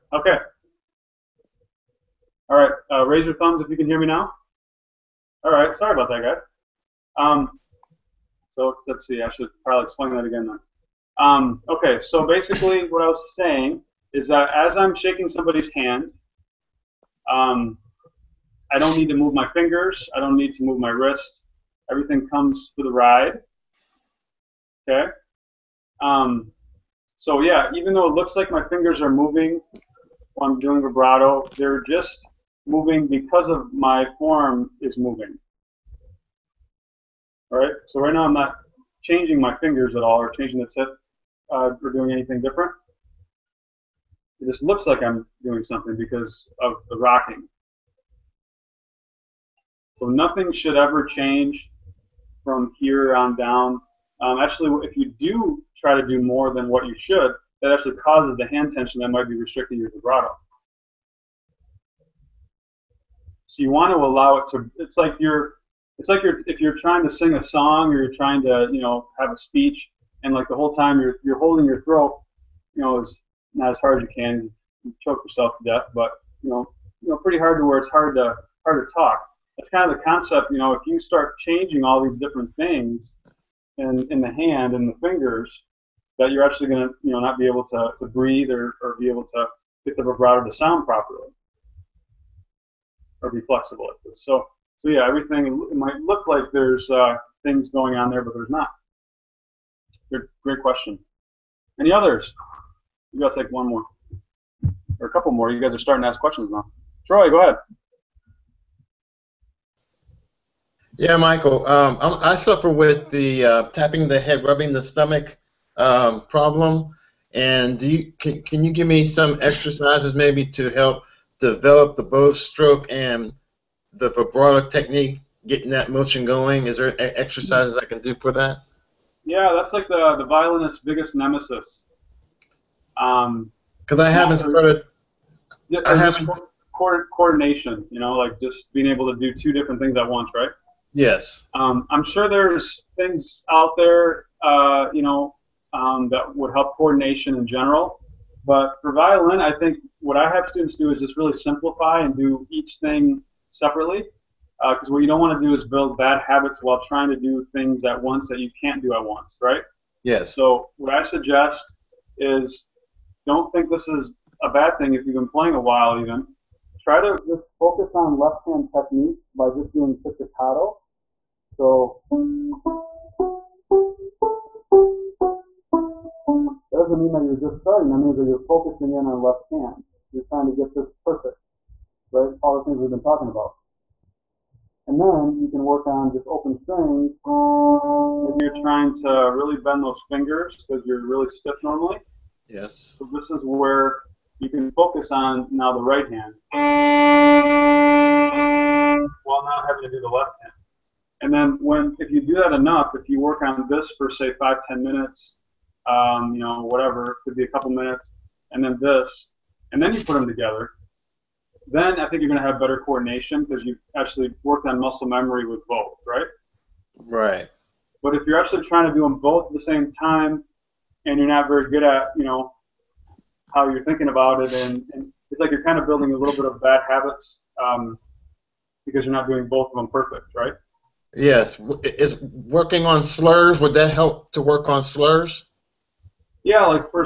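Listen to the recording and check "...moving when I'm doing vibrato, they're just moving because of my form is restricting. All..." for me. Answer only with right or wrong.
wrong.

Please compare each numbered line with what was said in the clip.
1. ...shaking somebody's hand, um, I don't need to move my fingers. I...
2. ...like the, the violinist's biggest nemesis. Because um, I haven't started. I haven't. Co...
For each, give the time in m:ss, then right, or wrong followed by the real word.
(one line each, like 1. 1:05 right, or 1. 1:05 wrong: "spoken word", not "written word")
1. 0:14 right
2. 2:09 right.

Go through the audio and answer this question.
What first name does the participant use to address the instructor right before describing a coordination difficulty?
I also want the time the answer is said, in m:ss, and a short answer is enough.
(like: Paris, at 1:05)
Michael, at 1:51.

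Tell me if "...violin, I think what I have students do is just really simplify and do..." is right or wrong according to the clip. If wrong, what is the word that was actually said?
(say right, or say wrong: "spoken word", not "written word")
right.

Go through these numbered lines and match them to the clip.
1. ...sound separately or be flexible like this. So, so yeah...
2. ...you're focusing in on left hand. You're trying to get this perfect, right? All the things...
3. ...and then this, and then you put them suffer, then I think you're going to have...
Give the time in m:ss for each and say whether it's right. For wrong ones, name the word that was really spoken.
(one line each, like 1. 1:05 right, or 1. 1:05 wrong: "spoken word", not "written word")
1. 1:30 wrong: "properly", not "separately"
2. 2:58 right
3. 3:28 wrong: "together", not "suffer".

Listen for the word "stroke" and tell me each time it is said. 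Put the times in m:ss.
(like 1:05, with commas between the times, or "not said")
2:02.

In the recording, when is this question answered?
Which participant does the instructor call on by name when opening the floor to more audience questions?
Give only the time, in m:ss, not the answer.
1:47.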